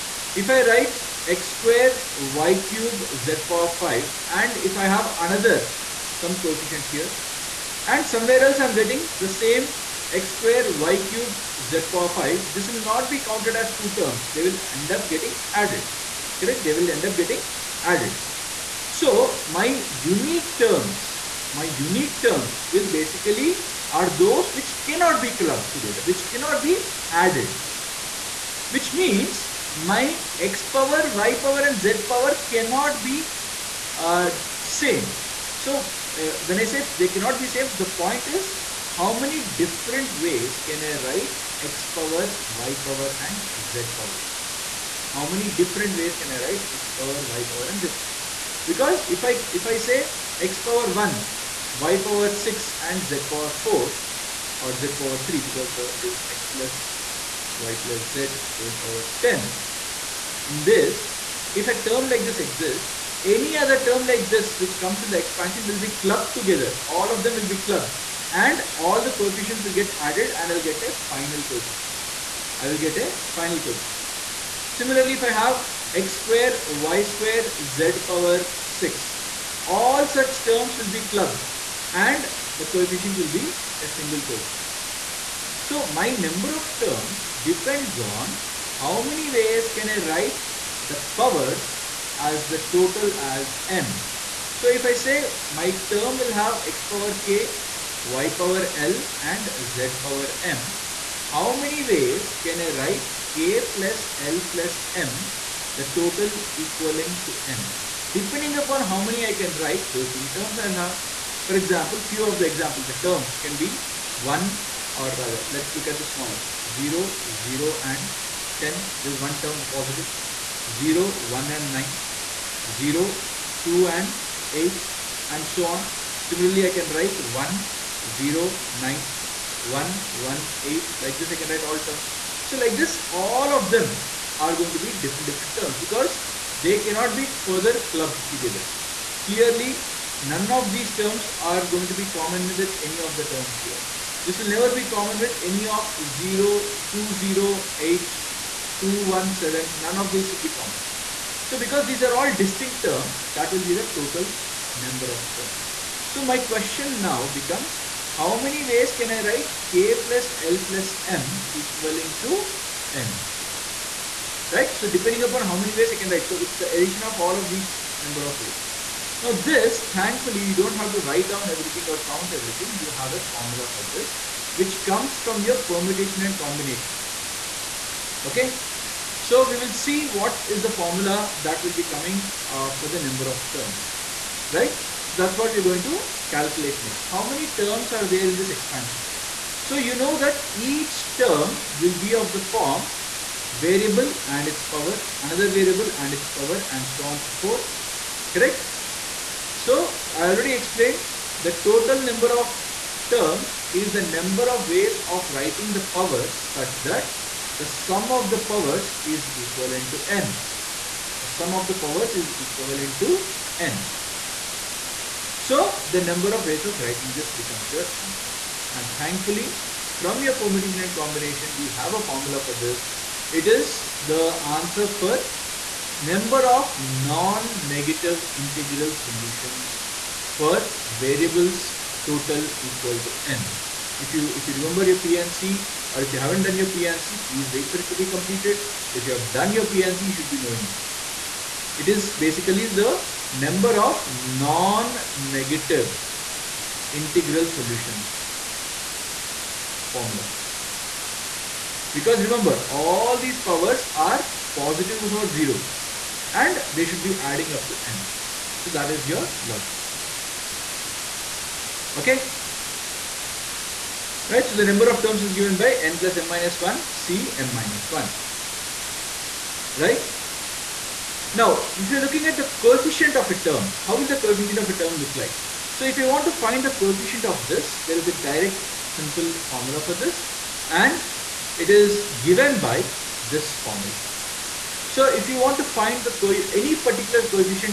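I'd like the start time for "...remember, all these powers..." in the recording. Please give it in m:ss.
4:12.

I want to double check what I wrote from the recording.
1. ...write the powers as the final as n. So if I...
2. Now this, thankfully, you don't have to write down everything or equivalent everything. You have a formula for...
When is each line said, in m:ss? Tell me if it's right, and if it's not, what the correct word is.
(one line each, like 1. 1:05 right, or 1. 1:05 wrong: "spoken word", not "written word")
1. 1:30 wrong: "total", not "final"
2. 2:49 wrong: "count", not "equivalent".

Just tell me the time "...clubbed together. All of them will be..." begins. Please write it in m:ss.
1:06.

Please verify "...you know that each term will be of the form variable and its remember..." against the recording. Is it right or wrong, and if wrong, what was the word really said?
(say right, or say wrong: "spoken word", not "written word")
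wrong: "power", not "remember".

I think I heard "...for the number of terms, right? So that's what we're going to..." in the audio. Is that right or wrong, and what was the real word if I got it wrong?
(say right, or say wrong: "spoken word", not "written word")
right.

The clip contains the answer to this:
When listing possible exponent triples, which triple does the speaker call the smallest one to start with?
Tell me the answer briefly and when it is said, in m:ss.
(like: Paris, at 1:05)
0, 0, 10, at 1:56.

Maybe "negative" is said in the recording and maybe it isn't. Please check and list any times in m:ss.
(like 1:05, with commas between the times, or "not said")
3:46, 4:04.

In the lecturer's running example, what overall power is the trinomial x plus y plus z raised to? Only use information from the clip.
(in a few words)
10.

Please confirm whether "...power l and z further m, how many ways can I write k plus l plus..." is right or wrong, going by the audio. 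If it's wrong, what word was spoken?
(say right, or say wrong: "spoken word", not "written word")
wrong: "power", not "further".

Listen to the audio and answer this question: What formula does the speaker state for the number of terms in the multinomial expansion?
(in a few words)
n+m-1 C m-1.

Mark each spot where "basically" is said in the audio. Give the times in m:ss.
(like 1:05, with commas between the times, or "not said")
0:22, 4:02.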